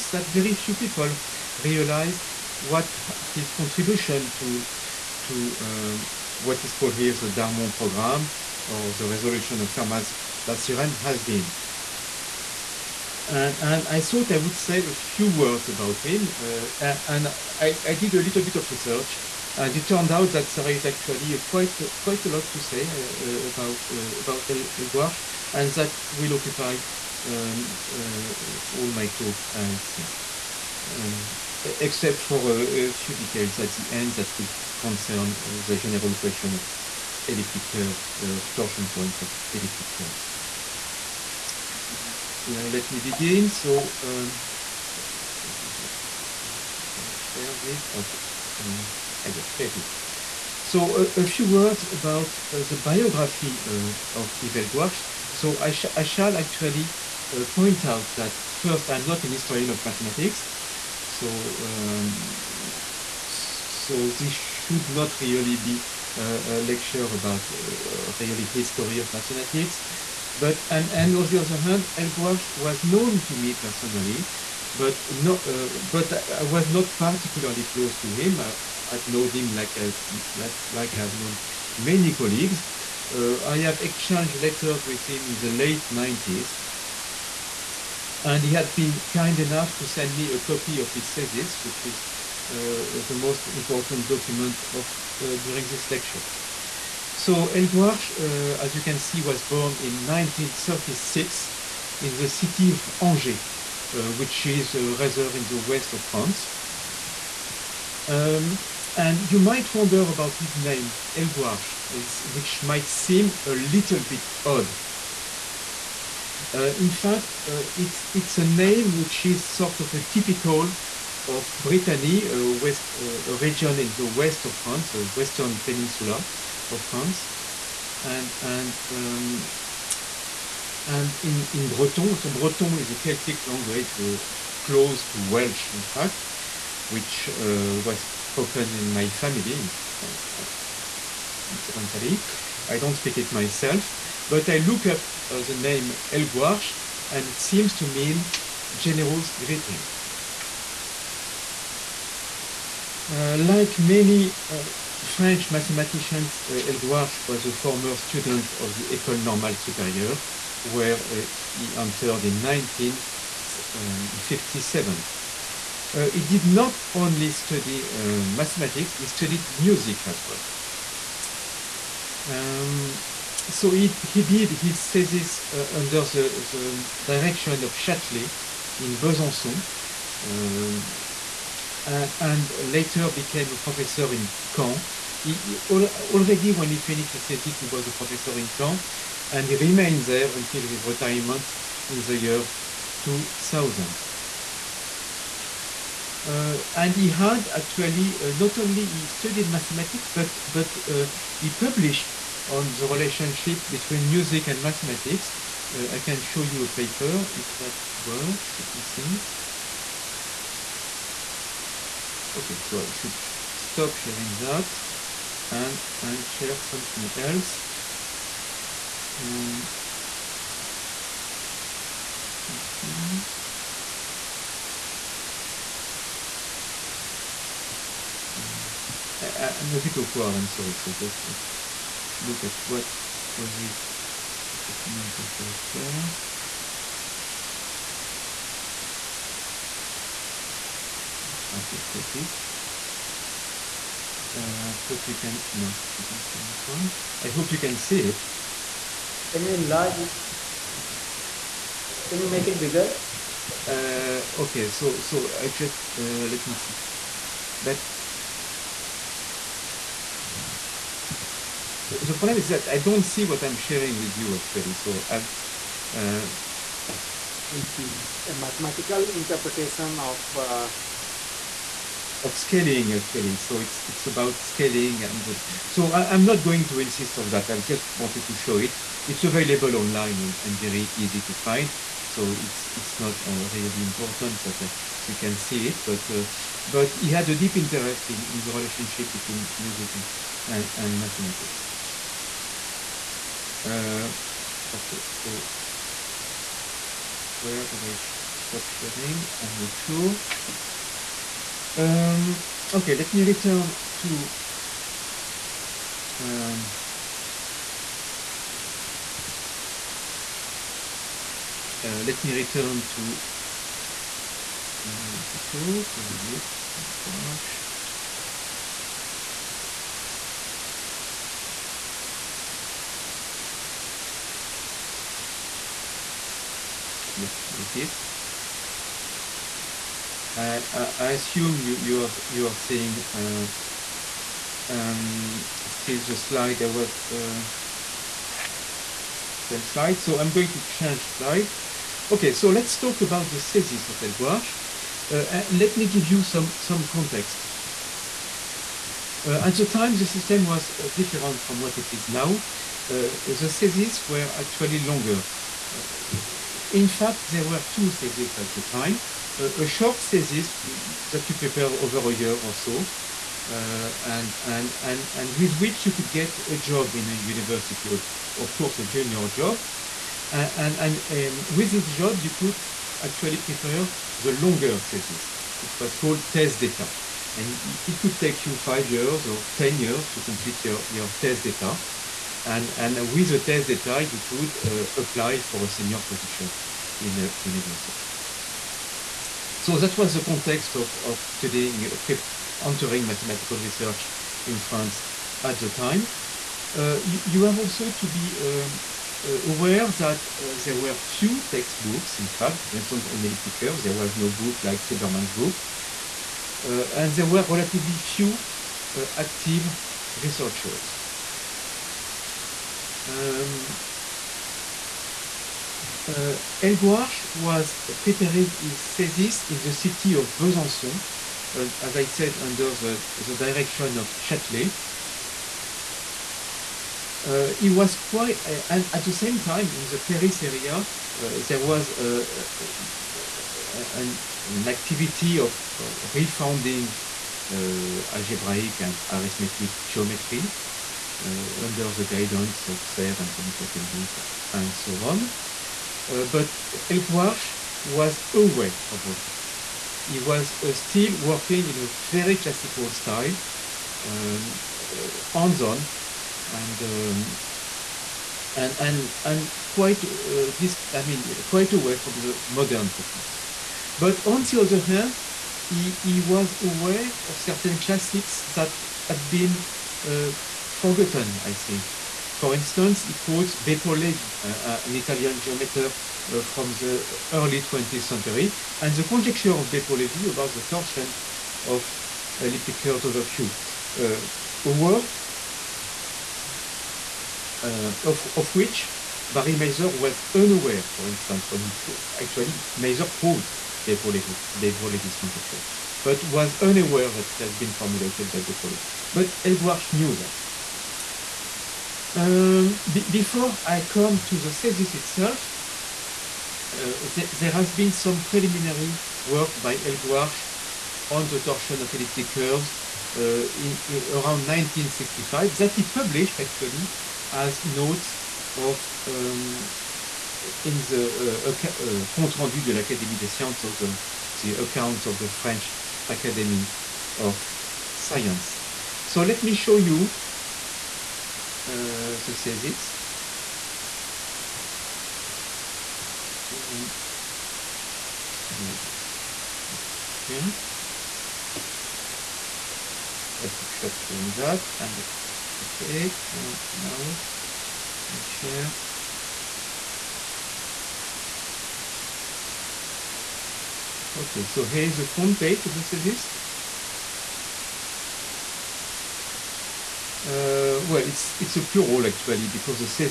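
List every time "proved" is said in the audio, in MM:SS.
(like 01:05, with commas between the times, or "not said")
08:13.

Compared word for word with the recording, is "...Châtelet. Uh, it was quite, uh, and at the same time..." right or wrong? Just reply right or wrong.
right.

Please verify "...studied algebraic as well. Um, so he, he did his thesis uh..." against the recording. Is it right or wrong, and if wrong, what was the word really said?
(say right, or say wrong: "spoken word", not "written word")
wrong: "music", not "algebraic".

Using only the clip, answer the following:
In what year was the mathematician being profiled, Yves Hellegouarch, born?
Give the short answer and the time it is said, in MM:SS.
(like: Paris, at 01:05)
1936, at 01:40.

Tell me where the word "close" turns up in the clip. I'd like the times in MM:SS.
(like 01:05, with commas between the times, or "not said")
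01:17, 02:14.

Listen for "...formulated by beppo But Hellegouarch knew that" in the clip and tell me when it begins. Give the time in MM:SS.
08:17.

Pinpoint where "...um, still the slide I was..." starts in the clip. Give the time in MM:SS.
05:34.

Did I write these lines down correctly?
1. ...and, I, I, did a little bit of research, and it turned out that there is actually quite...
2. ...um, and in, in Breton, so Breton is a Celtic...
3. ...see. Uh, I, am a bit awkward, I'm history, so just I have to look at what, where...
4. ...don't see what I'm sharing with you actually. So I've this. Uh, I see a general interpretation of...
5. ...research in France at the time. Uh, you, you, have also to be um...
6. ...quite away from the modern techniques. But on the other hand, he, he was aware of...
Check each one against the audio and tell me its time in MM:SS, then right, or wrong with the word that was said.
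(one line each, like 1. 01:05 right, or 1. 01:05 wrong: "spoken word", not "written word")
1. 00:17 right
2. 02:08 right
3. 03:42 wrong: "sorry", not "history"
4. 04:22 wrong: "mathematical", not "general"
5. 06:33 right
6. 07:41 right.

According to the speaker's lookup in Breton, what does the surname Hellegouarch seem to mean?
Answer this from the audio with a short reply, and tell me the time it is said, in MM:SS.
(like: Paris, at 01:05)
generous greeting, at 02:28.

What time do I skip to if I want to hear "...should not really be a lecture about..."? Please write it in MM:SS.
01:04.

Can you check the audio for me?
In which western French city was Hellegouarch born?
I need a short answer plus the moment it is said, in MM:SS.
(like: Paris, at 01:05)
Angers, at 01:43.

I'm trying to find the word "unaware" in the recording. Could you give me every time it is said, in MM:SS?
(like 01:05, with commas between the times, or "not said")
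08:10, 08:16.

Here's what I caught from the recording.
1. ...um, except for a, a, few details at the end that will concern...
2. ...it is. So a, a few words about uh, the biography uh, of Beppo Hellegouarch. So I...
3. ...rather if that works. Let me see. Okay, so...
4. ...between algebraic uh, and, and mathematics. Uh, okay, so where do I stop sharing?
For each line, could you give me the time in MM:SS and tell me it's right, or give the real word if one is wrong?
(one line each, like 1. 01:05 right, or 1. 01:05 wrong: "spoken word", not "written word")
1. 00:31 right
2. 00:49 wrong: "Yves", not "Beppo"
3. 03:26 wrong: "paper", not "rather"
4. 04:49 wrong: "music", not "algebraic".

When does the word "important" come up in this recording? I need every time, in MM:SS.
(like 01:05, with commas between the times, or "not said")
01:33, 04:43.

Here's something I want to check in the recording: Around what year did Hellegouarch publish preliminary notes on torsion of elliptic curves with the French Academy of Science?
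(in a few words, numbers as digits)
1965.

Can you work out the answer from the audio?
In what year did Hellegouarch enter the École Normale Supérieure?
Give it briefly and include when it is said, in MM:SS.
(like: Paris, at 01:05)
1957, at 02:42.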